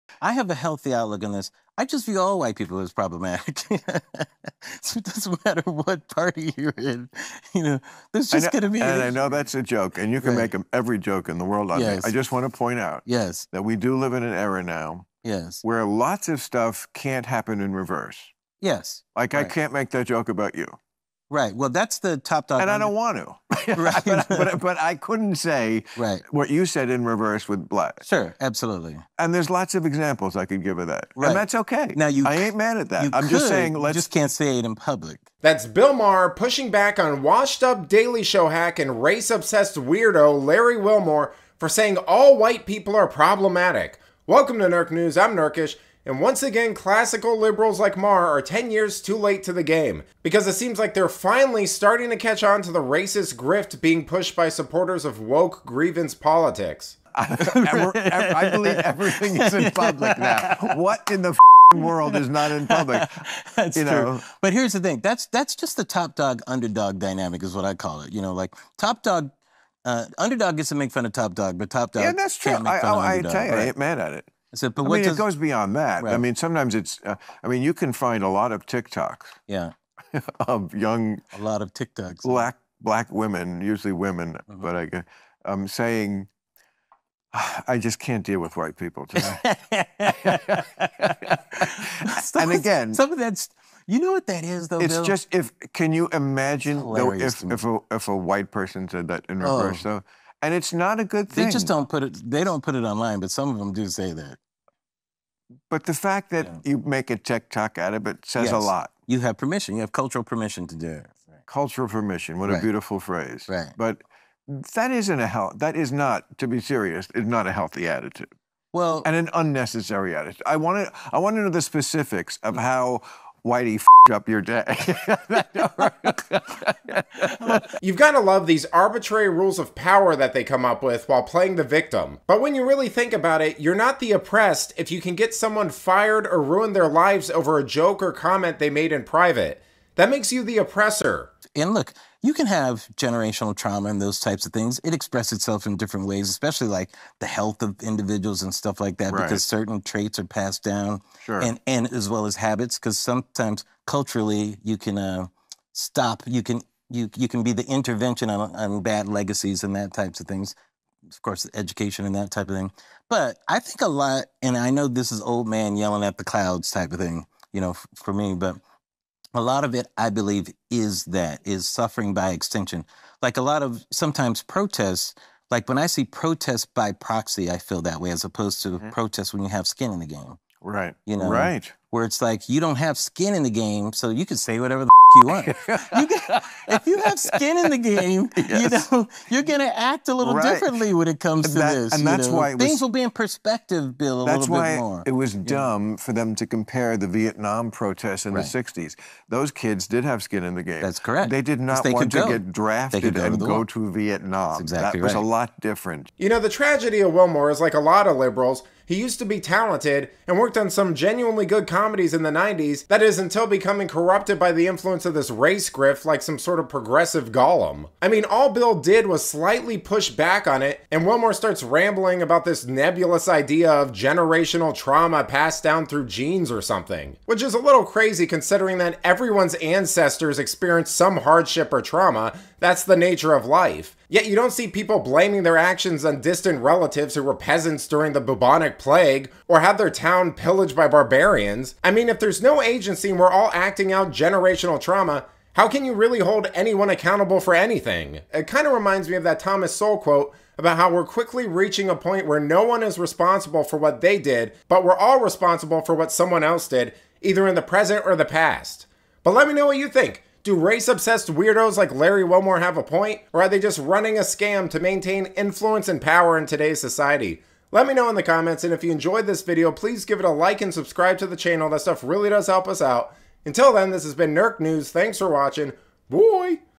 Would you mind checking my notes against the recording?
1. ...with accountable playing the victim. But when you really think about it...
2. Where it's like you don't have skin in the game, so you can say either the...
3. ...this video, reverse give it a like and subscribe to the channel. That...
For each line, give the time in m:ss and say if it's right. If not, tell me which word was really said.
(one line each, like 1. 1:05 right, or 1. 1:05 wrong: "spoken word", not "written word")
1. 2:10 wrong: "while", not "accountable"
2. 3:01 wrong: "whatever", not "either"
3. 4:29 wrong: "please", not "reverse".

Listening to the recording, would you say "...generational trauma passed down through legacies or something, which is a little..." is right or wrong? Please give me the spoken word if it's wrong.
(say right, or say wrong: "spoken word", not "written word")
wrong: "genes", not "legacies".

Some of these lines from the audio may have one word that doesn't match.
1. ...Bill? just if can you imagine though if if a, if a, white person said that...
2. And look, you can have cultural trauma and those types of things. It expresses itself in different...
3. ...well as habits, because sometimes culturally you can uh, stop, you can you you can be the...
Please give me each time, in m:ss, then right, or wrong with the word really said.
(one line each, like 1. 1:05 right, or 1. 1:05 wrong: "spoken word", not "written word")
1. 1:34 right
2. 2:21 wrong: "generational", not "cultural"
3. 2:32 right.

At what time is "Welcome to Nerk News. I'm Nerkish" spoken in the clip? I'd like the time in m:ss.
0:44.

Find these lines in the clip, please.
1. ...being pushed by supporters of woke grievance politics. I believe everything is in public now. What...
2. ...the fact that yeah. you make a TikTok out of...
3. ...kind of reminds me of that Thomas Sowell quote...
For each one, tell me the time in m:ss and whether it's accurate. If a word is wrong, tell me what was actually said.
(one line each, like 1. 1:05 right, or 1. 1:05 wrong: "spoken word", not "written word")
1. 0:53 right
2. 1:45 right
3. 4:08 right.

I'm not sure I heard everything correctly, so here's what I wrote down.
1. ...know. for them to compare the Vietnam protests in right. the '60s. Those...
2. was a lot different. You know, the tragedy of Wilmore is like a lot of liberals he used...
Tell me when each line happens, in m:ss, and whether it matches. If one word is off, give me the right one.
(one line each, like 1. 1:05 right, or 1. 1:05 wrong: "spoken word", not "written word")
1. 3:15 right
2. 3:25 right.